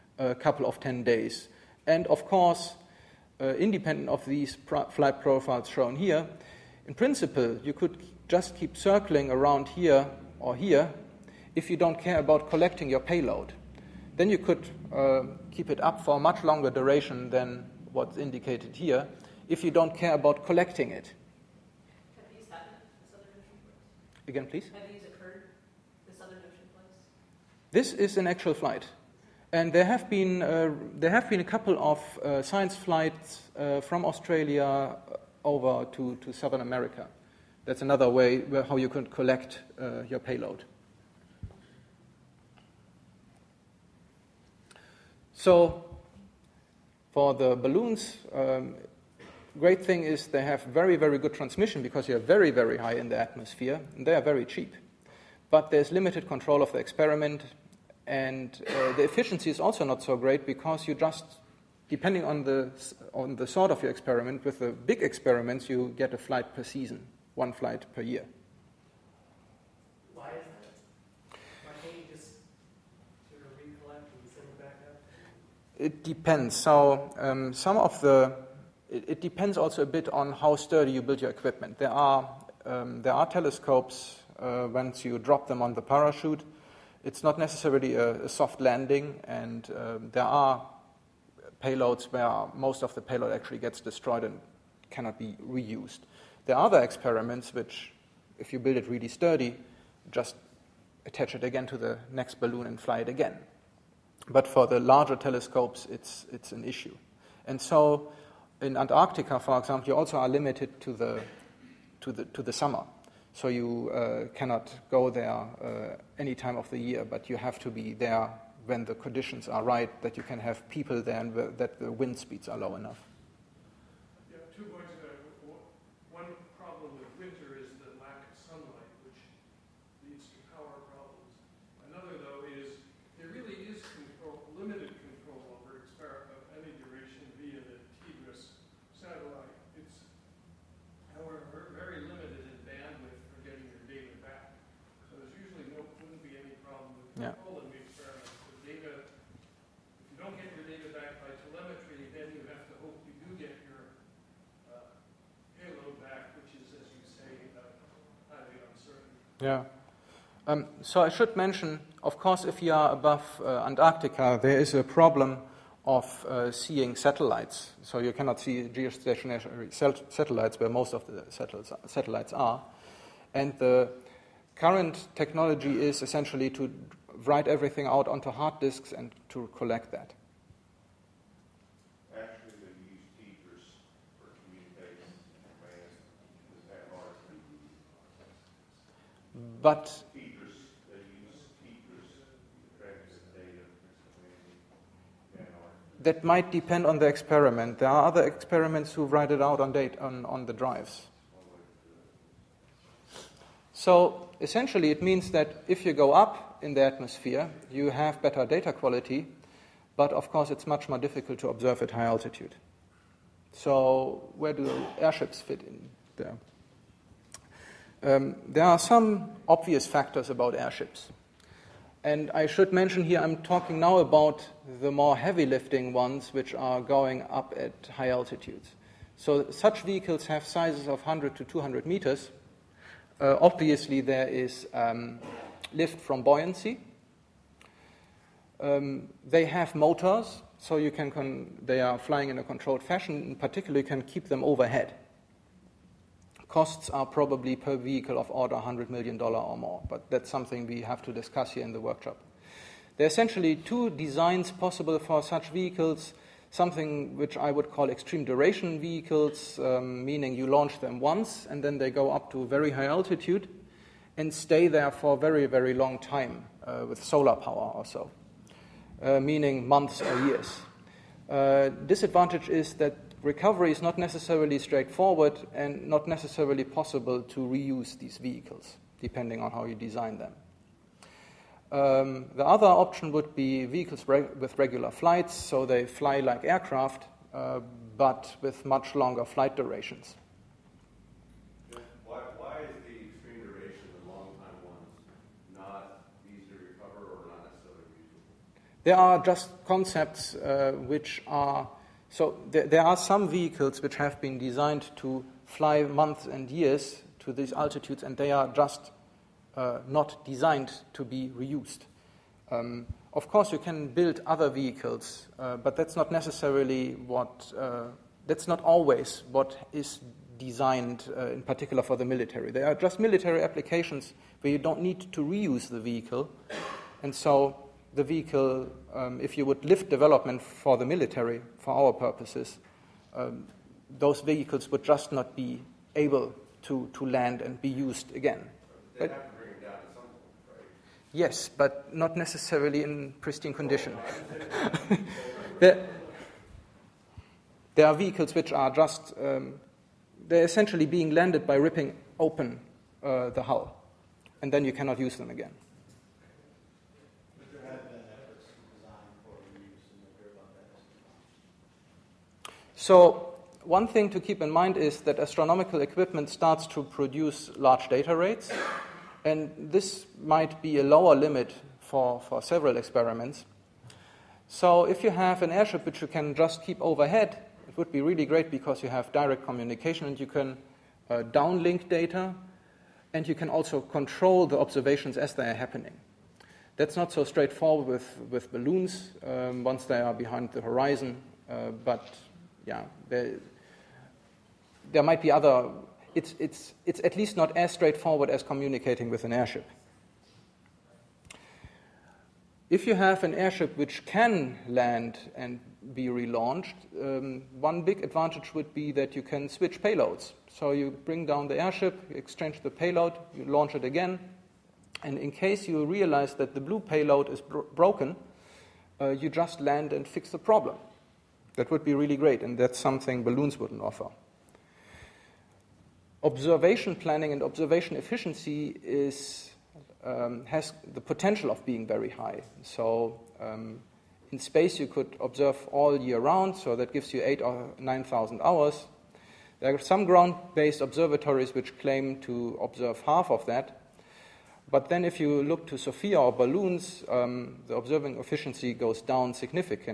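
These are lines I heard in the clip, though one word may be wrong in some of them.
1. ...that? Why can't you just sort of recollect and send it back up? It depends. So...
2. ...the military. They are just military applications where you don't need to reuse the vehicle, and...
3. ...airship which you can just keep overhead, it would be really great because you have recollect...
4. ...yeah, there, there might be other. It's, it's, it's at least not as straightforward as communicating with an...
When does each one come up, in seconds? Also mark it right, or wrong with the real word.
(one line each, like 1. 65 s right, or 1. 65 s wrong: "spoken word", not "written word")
1. 70 s right
2. 321 s right
3. 375 s wrong: "direct", not "recollect"
4. 392 s right.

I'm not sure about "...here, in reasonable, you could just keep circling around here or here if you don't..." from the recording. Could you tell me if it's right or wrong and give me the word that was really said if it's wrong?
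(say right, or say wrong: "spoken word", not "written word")
wrong: "principle", not "reasonable".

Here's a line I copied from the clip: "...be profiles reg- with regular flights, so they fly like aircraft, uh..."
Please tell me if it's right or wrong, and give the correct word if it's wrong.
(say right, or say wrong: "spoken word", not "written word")
wrong: "vehicles", not "profiles".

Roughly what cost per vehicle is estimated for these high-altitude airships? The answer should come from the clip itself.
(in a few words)
$100 million.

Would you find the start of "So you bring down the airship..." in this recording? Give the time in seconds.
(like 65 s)
410 s.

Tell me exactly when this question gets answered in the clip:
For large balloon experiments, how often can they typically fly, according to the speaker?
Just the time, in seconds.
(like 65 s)
67 s.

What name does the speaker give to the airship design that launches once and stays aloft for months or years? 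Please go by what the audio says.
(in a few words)
Extreme duration vehicles.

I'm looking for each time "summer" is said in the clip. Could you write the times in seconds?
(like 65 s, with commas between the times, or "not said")
112 s.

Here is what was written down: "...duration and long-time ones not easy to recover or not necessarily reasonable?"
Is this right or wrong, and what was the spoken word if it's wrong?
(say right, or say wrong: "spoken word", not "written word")
right.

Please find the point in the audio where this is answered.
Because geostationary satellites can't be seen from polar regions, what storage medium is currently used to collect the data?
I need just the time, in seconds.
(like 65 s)
178 s.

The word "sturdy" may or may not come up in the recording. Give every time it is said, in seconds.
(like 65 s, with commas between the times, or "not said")
80 s, 99 s.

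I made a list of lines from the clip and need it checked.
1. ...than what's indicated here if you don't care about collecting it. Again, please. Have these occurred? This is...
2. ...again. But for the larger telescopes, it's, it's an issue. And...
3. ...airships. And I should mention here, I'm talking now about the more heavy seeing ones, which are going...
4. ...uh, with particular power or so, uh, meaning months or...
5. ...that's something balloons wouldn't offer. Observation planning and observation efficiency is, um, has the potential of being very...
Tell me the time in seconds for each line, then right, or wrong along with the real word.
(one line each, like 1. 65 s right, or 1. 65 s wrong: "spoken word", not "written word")
1. 17 s right
2. 103 s right
3. 220 s wrong: "lifting", not "seeing"
4. 266 s wrong: "solar", not "particular"
5. 422 s right.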